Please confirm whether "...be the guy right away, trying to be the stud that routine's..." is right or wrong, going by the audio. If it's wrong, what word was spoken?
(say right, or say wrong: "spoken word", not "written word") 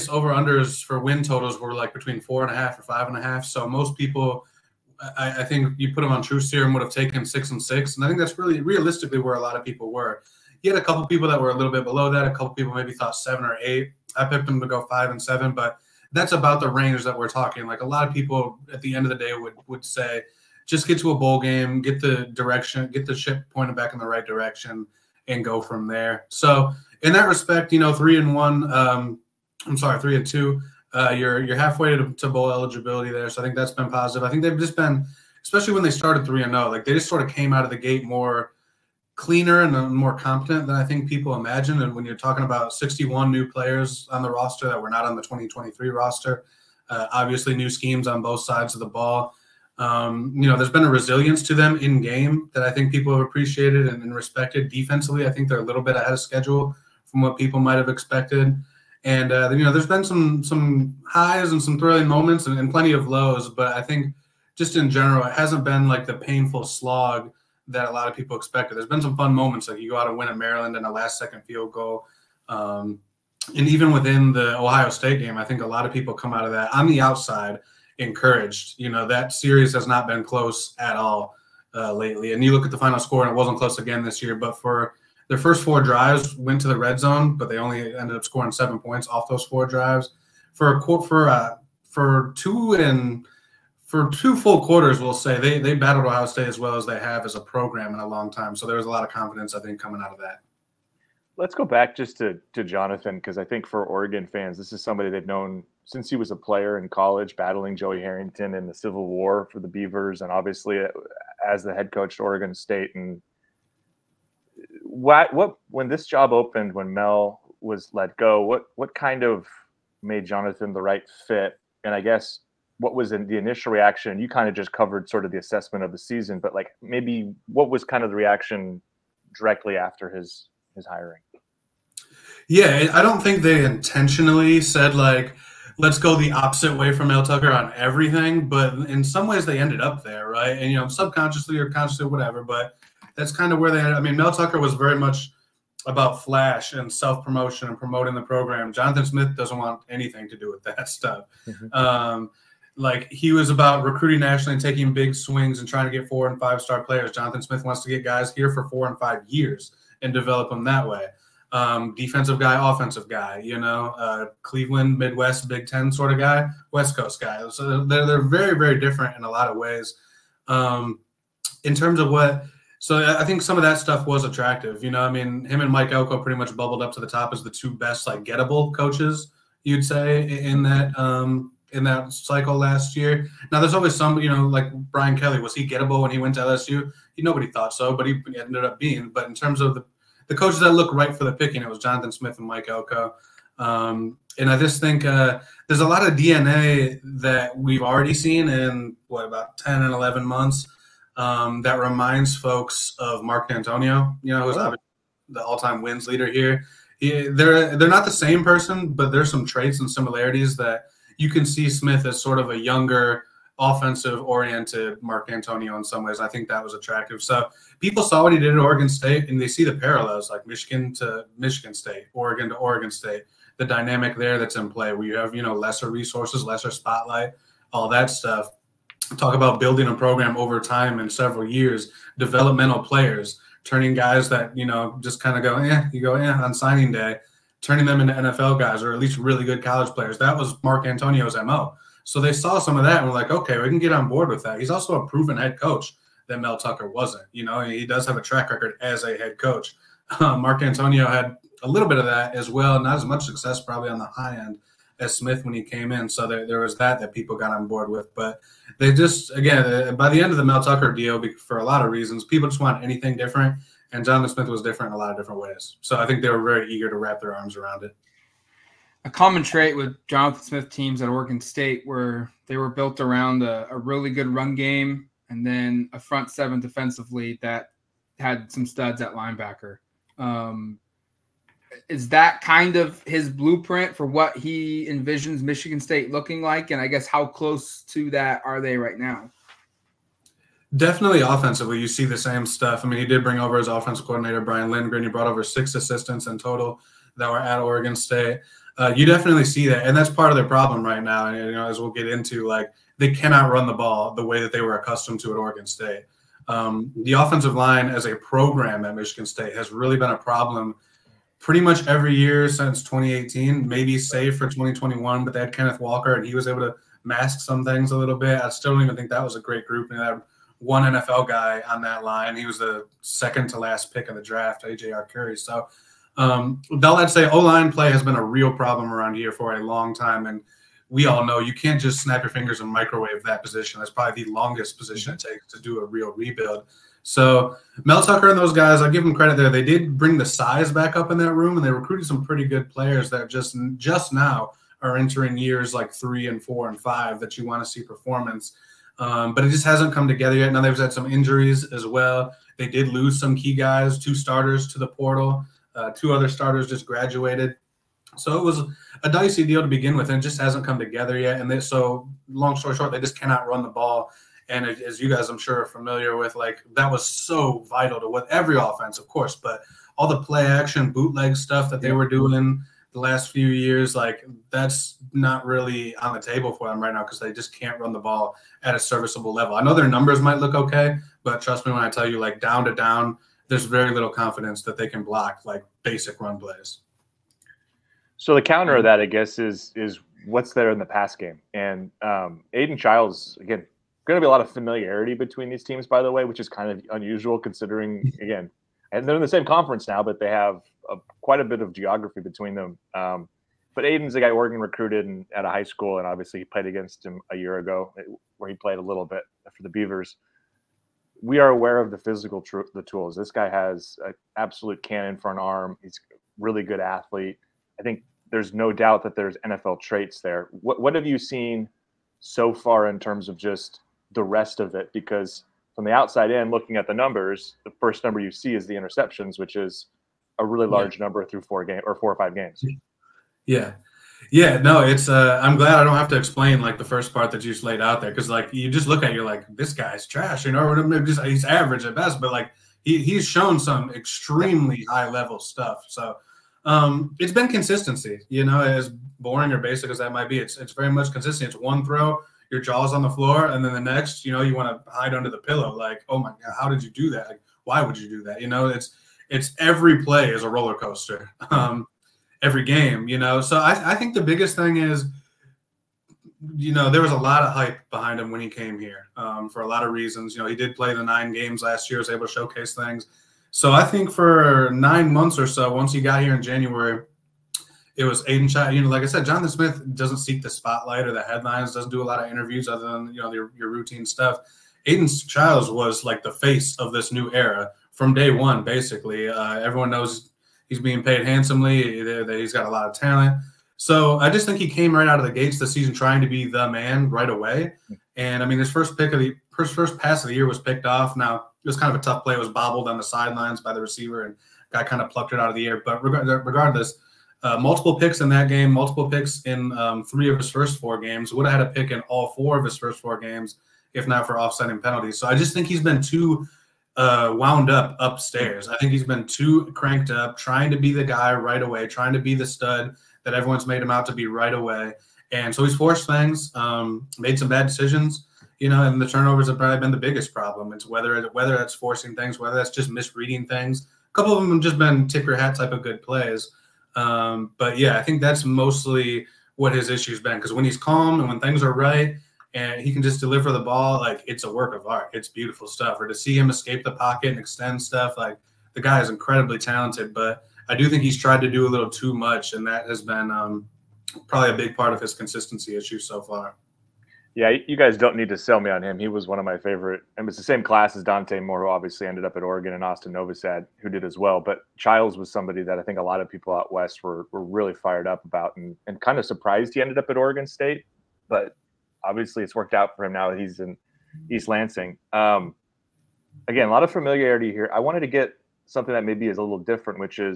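wrong: "everyone", not "routine".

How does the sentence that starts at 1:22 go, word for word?
And you look at the final score, and it wasn't close again this year.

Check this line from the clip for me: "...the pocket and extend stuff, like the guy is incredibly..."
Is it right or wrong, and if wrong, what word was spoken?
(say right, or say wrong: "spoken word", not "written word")
right.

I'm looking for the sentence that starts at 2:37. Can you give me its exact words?
Jonathan Smith wants to get guys here for four and five years and develop them that way.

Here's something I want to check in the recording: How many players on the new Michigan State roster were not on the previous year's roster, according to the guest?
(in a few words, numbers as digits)
61.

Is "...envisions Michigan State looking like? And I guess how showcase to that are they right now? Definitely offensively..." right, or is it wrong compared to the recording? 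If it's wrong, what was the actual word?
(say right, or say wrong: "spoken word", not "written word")
wrong: "close", not "showcase".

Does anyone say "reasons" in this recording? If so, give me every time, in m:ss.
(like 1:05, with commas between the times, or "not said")
4:21, 7:49.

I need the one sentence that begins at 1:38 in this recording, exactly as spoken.
So there was a lot of confidence, I think, coming out of that.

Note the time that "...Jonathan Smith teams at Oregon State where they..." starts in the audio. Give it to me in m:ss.
4:30.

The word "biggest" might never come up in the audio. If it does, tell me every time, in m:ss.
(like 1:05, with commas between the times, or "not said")
7:44, 8:49.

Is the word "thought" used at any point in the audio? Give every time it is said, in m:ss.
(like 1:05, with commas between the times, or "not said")
0:12, 3:07.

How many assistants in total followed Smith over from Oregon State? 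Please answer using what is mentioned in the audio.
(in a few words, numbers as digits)
6.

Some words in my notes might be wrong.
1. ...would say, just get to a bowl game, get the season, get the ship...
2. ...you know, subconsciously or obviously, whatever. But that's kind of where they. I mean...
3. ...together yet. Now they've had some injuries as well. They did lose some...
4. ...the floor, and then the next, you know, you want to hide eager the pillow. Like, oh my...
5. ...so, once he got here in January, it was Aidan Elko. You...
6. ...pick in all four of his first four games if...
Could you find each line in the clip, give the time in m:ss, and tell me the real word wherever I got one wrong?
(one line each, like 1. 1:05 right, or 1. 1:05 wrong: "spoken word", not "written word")
1. 0:19 wrong: "direction", not "season"
2. 2:20 wrong: "consciously", not "obviously"
3. 5:50 right
4. 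7:33 wrong: "under", not "eager"
5. 7:55 wrong: "Chiles", not "Elko"
6. 8:31 right.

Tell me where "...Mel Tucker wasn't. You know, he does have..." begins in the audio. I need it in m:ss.
4:06.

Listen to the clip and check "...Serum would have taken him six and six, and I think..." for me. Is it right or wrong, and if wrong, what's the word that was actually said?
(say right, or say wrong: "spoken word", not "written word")
right.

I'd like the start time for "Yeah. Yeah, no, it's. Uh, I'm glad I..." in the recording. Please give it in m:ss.
7:13.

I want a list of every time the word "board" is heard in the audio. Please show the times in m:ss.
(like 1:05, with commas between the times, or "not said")
4:04, 4:17.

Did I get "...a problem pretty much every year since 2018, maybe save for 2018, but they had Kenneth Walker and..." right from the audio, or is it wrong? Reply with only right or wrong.
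wrong.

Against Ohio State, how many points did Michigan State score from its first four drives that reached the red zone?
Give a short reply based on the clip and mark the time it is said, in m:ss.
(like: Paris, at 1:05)
7, at 1:28.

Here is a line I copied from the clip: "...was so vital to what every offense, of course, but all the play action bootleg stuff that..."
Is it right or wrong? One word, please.
right.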